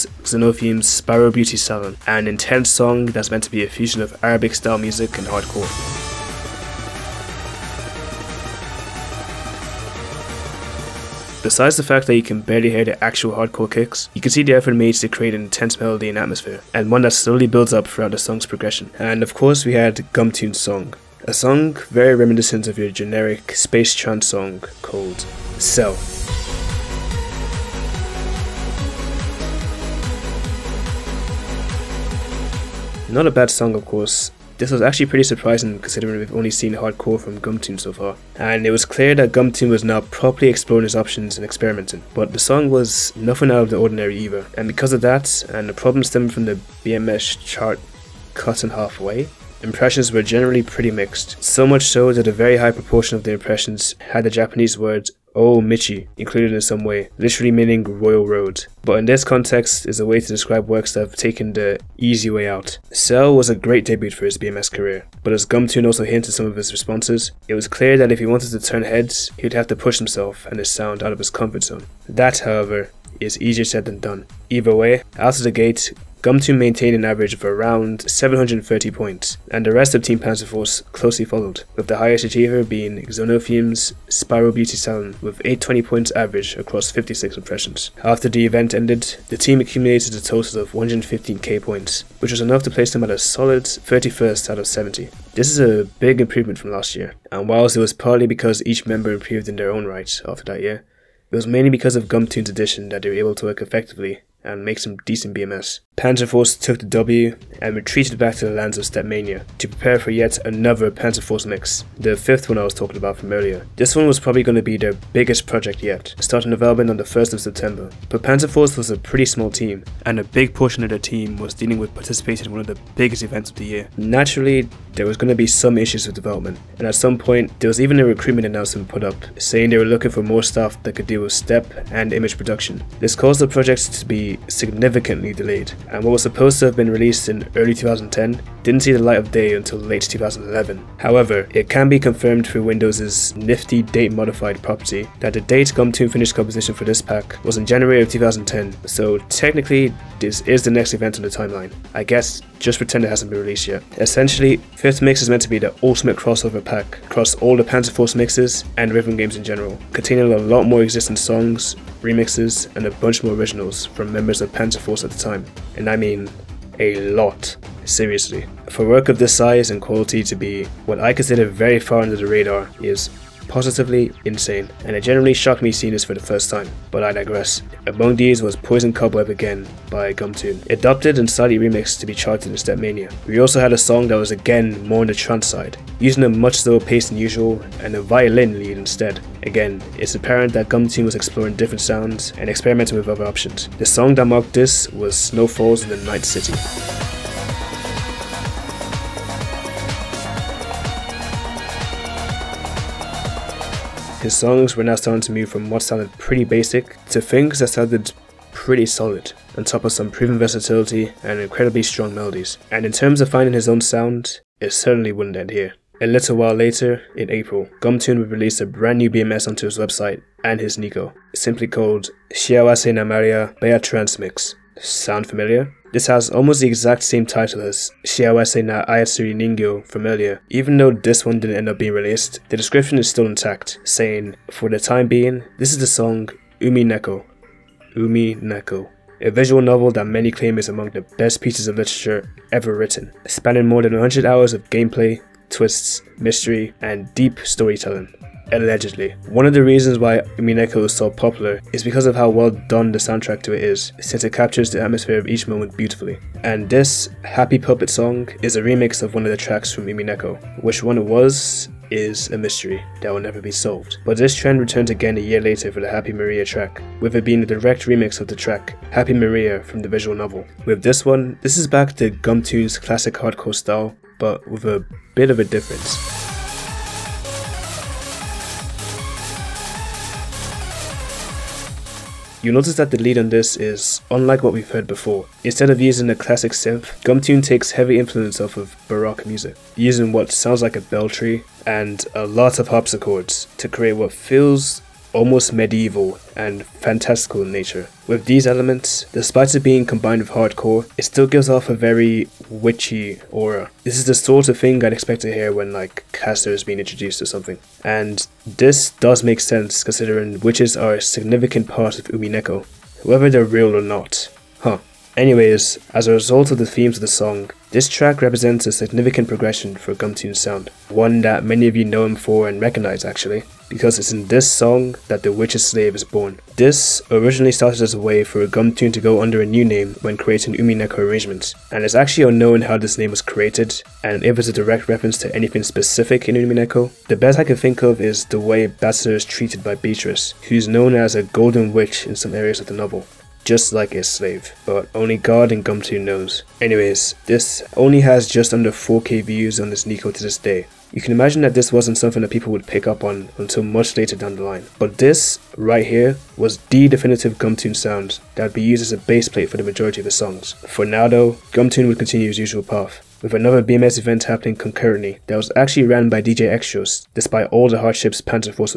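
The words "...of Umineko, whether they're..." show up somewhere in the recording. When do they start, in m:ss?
5:11.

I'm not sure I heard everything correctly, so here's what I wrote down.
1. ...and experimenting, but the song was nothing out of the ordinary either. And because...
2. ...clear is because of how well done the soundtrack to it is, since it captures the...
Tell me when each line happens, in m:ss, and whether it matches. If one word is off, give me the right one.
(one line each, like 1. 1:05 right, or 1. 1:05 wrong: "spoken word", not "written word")
1. 0:41 right
2. 4:11 wrong: "popular", not "clear".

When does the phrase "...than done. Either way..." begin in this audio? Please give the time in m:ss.
1:13.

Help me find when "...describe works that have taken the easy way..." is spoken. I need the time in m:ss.
1:00.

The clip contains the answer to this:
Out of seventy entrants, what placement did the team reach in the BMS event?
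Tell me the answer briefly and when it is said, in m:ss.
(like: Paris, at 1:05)
31st, at 1:33.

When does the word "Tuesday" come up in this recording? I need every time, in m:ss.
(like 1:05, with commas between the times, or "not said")
not said.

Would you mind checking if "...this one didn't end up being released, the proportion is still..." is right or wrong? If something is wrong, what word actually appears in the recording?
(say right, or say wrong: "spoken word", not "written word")
wrong: "description", not "proportion".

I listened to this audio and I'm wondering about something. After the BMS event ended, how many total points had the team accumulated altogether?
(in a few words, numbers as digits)
115k.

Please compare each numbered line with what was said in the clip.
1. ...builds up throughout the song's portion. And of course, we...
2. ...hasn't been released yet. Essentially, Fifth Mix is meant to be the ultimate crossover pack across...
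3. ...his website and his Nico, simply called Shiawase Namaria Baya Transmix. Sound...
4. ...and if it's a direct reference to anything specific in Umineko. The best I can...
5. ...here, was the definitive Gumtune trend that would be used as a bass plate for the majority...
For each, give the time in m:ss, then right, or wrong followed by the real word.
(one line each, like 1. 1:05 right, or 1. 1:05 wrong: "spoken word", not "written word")
1. 0:17 wrong: "progression", not "portion"
2. 2:33 right
3. 3:39 right
4. 5:34 right
5. 5:55 wrong: "sound", not "trend".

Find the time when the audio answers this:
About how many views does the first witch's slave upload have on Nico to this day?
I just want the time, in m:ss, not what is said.
5:48.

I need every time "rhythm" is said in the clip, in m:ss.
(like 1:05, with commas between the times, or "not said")
2:38.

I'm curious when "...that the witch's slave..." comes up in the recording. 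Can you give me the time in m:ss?
5:25.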